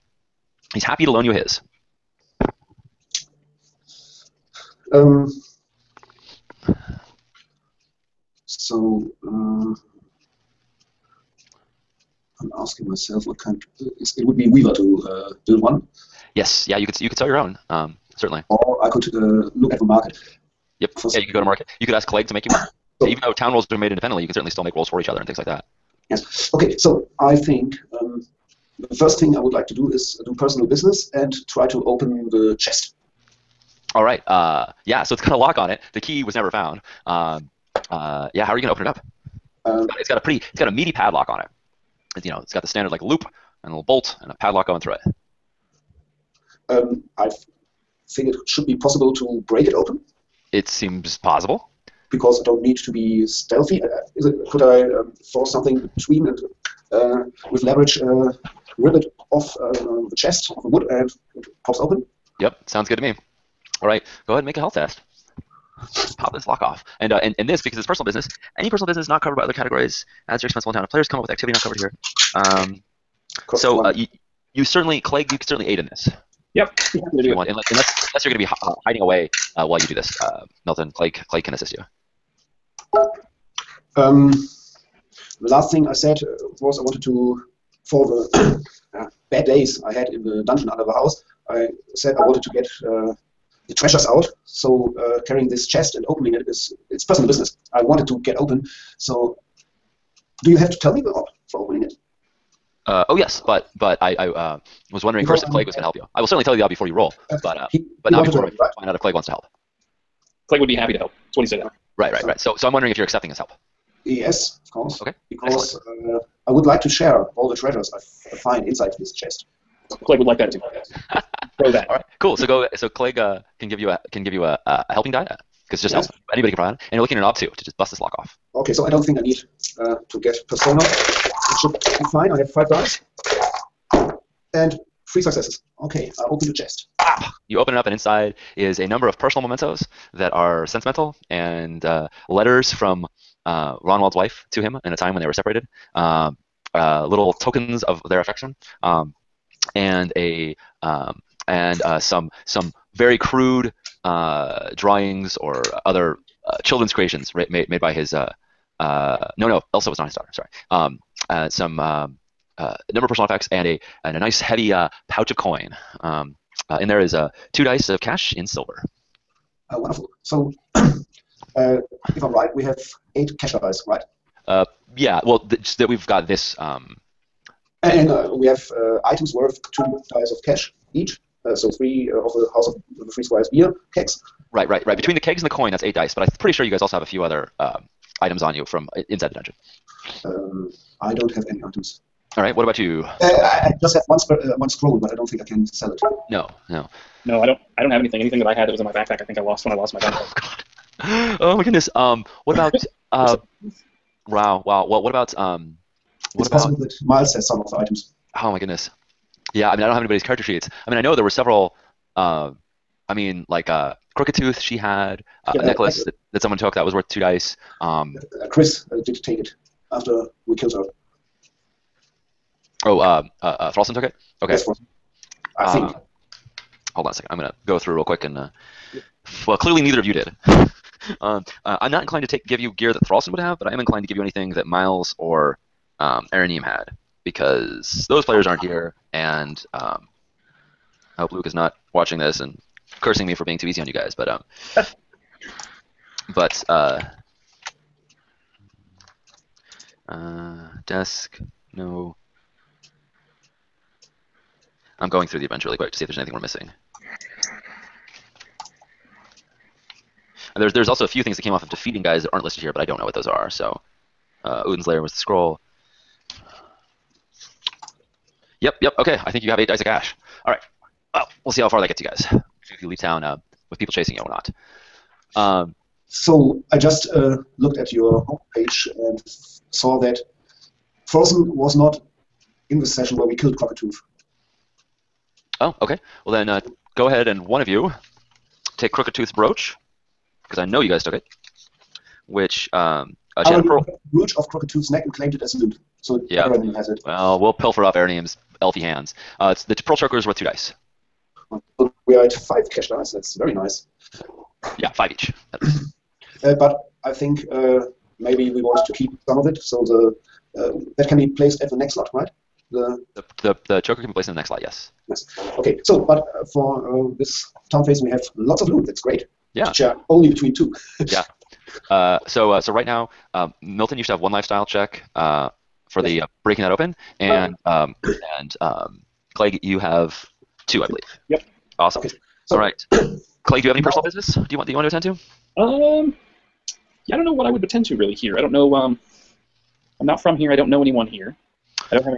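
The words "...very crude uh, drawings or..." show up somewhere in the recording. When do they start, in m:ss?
2:32.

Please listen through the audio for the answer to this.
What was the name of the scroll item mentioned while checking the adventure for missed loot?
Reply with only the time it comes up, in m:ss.
4:24.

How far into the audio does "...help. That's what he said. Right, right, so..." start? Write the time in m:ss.
1:50.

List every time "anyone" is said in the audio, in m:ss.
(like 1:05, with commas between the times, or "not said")
5:40.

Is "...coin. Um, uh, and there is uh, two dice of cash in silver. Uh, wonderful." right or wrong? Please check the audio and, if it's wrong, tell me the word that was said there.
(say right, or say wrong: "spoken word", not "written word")
right.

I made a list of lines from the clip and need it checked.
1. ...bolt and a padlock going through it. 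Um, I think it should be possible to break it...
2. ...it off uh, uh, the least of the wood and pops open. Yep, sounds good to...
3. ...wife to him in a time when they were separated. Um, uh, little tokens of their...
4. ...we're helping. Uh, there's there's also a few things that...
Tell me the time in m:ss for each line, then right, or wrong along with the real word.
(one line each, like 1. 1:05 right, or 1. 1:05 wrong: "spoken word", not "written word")
1. 0:43 right
2. 0:58 wrong: "chest", not "least"
3. 2:24 right
4. 4:16 wrong: "missing", not "helping".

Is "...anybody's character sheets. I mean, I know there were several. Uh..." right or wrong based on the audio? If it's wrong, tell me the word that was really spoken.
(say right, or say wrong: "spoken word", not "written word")
right.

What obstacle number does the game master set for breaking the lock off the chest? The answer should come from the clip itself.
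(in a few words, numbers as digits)
2.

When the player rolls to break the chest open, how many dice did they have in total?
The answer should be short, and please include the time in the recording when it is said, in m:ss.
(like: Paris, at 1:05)
5, at 2:12.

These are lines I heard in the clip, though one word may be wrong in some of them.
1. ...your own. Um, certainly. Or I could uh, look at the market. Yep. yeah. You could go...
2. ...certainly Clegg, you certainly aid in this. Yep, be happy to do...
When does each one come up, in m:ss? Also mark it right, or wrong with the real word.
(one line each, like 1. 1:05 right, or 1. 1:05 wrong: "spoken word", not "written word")
1. 0:17 right
2. 1:14 right.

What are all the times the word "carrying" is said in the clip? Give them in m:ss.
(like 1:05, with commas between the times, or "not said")
1:35.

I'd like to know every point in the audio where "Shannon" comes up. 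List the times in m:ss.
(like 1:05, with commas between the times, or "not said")
4:53.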